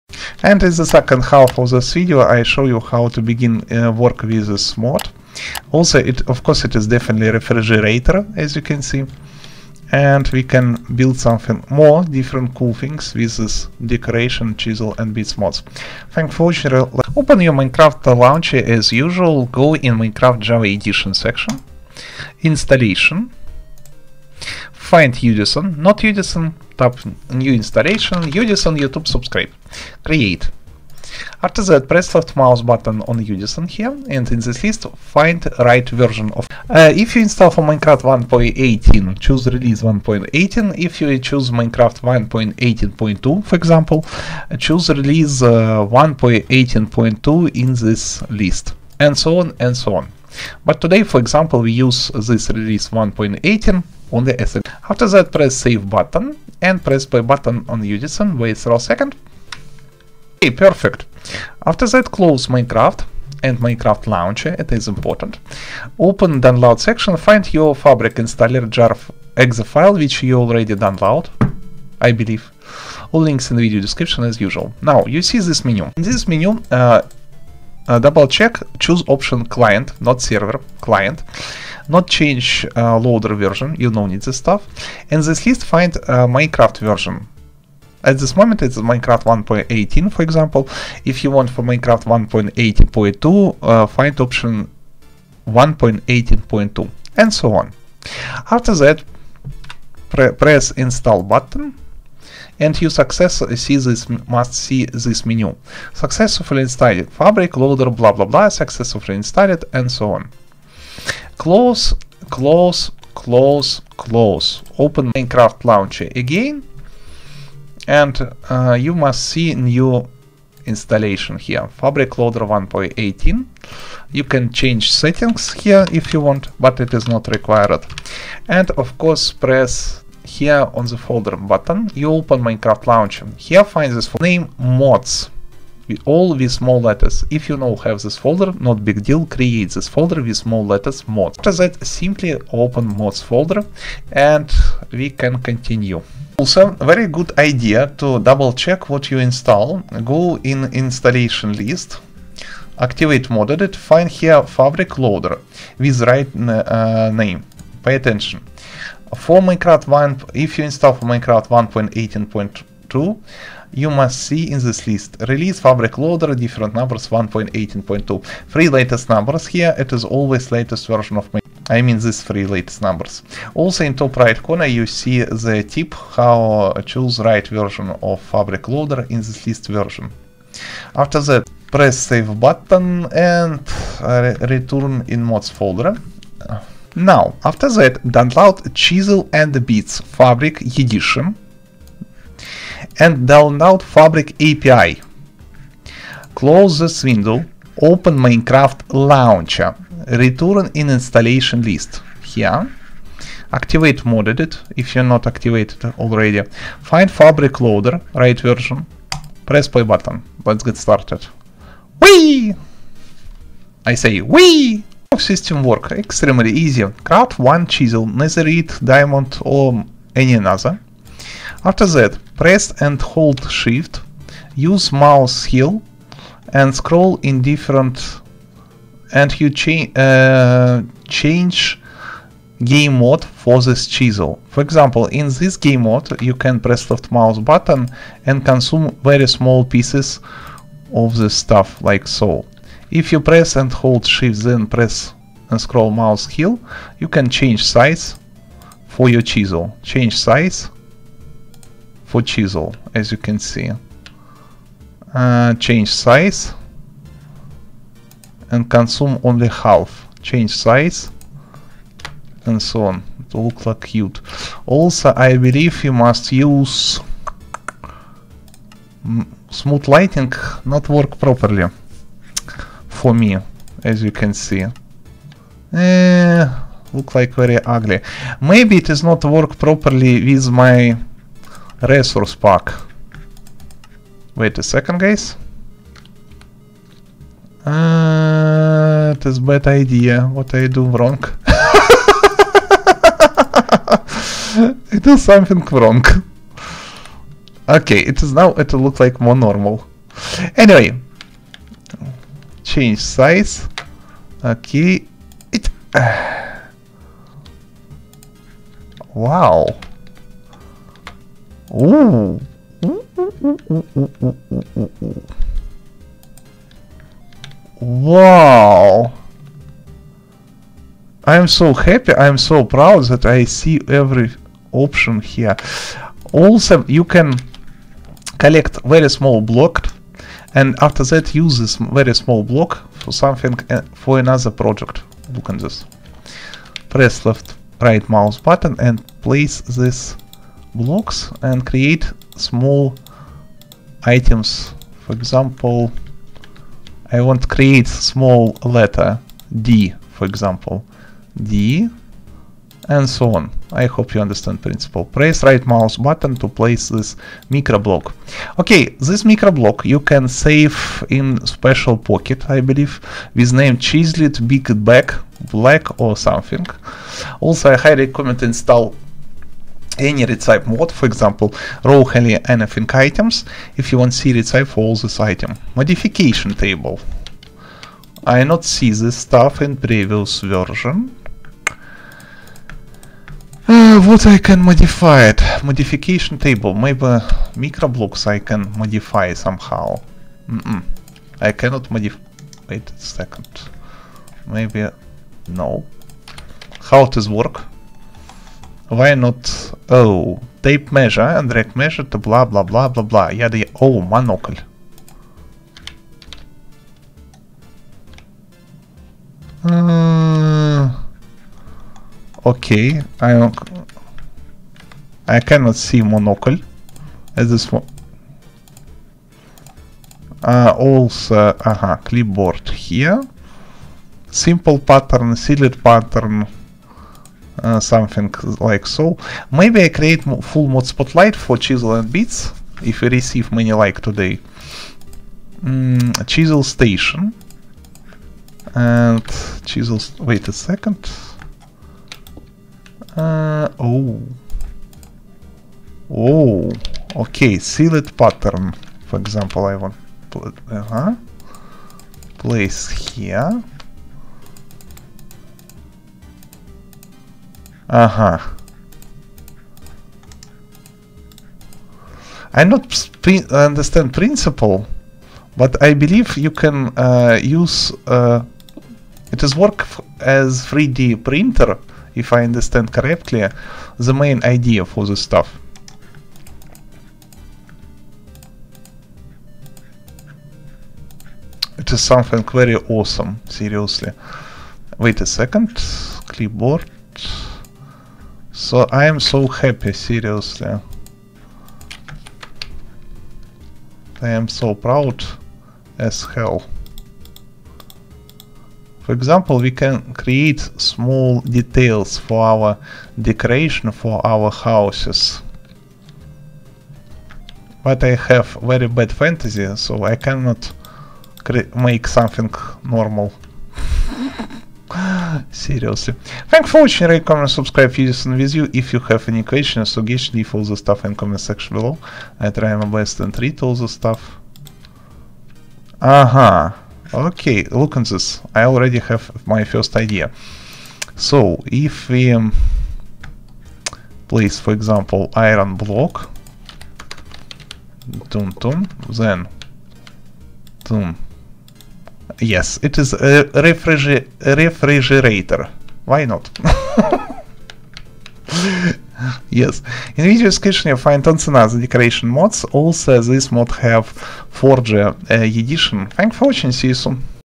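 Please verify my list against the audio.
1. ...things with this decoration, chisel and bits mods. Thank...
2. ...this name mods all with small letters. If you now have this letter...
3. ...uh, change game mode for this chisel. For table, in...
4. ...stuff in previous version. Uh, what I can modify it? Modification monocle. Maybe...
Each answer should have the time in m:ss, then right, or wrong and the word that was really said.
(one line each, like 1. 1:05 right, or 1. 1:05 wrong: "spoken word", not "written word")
1. 0:12 right
2. 2:13 wrong: "folder", not "letter"
3. 3:49 wrong: "example", not "table"
4. 6:19 wrong: "table", not "monocle".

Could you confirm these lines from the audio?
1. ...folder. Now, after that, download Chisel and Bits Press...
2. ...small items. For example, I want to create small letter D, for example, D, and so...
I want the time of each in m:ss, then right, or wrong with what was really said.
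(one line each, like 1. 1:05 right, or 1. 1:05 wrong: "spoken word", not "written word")
1. 3:05 wrong: "Fabric", not "Press"
2. 5:42 right.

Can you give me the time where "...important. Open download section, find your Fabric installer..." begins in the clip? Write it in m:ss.
1:04.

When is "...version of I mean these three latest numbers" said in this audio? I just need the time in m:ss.
2:50.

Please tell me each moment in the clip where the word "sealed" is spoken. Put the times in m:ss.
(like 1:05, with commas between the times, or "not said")
7:05, 7:27.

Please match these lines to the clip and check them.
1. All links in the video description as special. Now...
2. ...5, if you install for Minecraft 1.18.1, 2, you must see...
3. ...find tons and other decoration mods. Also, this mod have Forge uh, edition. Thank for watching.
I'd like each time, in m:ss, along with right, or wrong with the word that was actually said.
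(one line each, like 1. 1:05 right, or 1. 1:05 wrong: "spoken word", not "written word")
1. 1:13 wrong: "usual", not "special"
2. 2:39 wrong: "1", not "5"
3. 9:10 right.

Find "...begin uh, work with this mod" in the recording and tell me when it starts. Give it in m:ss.
0:03.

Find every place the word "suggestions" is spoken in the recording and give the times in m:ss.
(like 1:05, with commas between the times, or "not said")
8:39.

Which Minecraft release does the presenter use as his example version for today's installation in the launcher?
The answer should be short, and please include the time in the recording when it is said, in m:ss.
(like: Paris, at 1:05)
1.18, at 0:51.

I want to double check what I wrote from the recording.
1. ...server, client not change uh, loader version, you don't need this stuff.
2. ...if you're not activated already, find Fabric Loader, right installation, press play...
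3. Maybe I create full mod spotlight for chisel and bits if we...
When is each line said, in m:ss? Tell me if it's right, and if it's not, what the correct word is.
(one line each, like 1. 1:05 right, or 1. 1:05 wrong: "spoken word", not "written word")
1. 1:20 right
2. 3:24 wrong: "version", not "installation"
3. 7:09 right.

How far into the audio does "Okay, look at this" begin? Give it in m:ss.
8:47.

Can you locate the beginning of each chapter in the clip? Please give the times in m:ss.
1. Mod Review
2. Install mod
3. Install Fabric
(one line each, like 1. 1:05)
1. 3:16
2. 2:19
3. 1:03.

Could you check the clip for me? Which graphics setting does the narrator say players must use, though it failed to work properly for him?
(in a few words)
smooth lighting.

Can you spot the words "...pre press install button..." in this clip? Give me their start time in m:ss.
1:40.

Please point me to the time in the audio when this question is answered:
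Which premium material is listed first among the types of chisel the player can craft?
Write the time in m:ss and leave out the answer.
3:38.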